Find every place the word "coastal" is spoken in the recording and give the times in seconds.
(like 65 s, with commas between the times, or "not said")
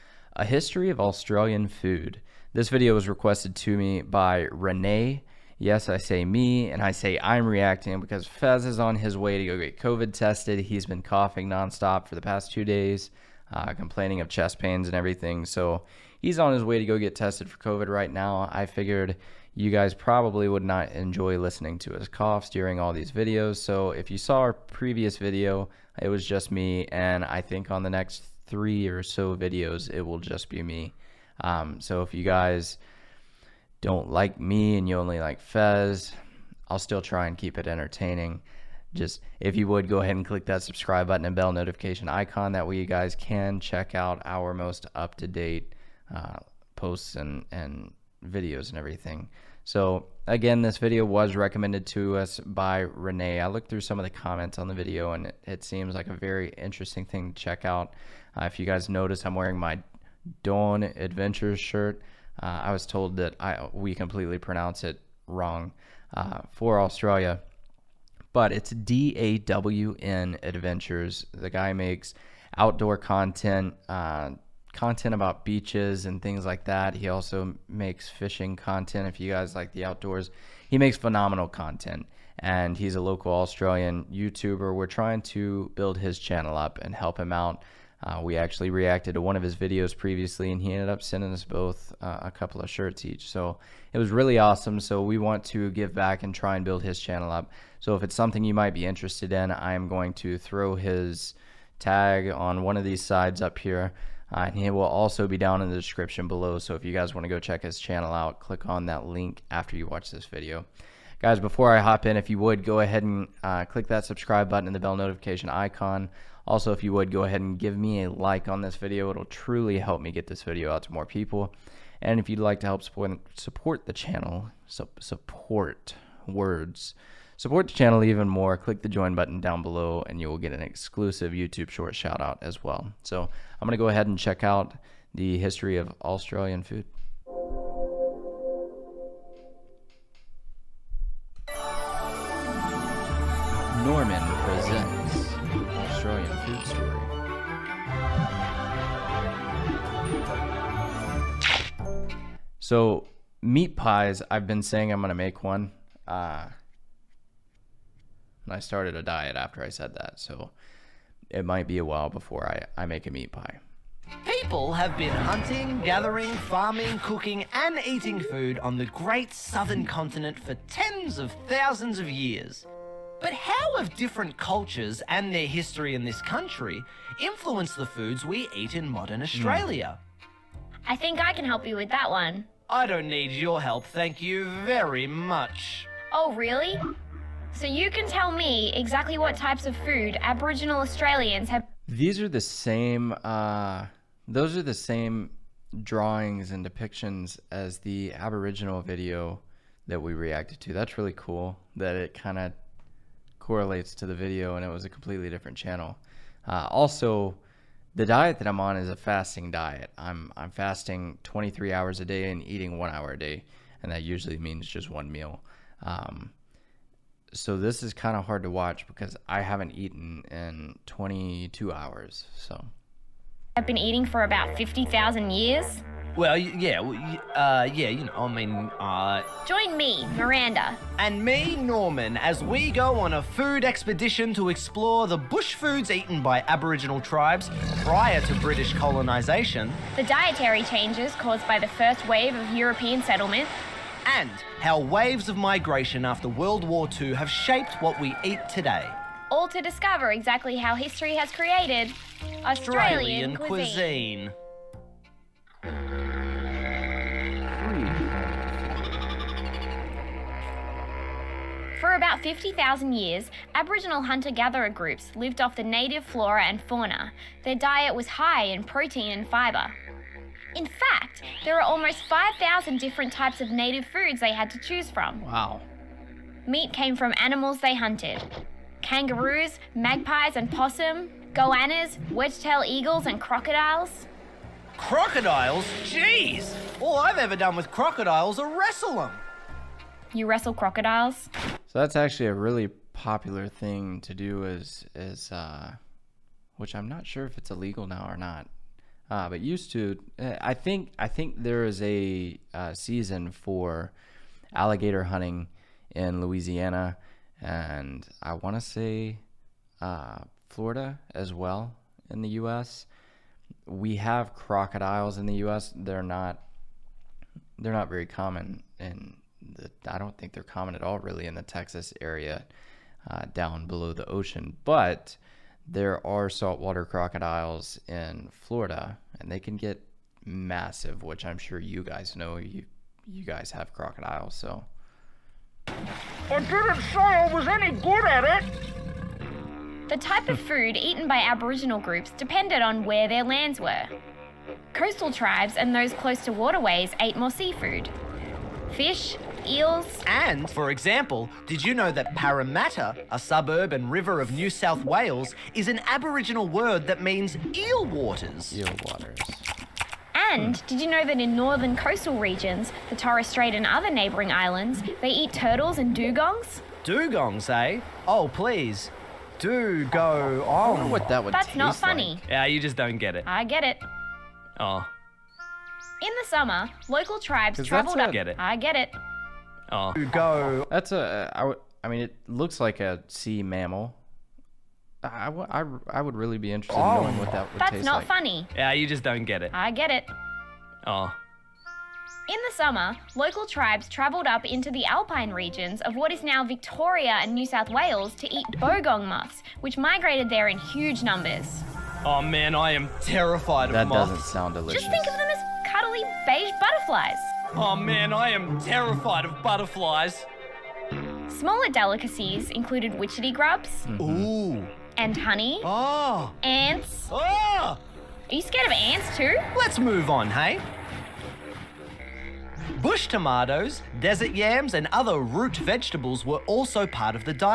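344 s, 361 s.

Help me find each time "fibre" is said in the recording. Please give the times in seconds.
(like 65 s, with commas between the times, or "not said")
269 s.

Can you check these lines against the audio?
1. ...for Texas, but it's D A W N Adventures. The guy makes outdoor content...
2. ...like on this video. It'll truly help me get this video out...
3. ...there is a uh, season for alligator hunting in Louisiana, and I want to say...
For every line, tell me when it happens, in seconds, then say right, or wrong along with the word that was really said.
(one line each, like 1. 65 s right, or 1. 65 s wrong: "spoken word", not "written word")
1. 66 s wrong: "Australia", not "Texas"
2. 118 s right
3. 301 s right.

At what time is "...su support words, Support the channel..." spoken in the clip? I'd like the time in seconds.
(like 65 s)
124 s.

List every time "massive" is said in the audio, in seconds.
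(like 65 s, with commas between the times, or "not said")
330 s.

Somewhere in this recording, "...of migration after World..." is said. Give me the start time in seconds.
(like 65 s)
245 s.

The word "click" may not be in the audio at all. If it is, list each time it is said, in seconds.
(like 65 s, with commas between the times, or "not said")
40 s, 108 s, 113 s, 128 s.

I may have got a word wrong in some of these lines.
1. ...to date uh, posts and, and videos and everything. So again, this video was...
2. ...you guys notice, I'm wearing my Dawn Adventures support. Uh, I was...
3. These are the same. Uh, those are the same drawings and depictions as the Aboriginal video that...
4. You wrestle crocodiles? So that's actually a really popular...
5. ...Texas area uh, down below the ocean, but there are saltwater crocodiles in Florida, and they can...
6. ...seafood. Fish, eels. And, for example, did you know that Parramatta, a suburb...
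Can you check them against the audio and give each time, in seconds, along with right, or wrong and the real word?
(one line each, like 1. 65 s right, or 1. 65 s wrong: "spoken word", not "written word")
1. 45 s right
2. 58 s wrong: "shirt", not "support"
3. 191 s right
4. 290 s right
5. 321 s right
6. 347 s right.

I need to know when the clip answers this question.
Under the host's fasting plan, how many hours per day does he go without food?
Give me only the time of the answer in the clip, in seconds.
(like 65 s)
211 s.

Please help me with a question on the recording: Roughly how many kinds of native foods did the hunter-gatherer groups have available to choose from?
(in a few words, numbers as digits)
5,000.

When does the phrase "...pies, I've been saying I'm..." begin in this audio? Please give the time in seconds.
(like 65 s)
153 s.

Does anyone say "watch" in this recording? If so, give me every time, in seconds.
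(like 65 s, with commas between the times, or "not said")
109 s, 218 s.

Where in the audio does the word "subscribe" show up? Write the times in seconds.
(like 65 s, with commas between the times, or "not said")
40 s, 114 s.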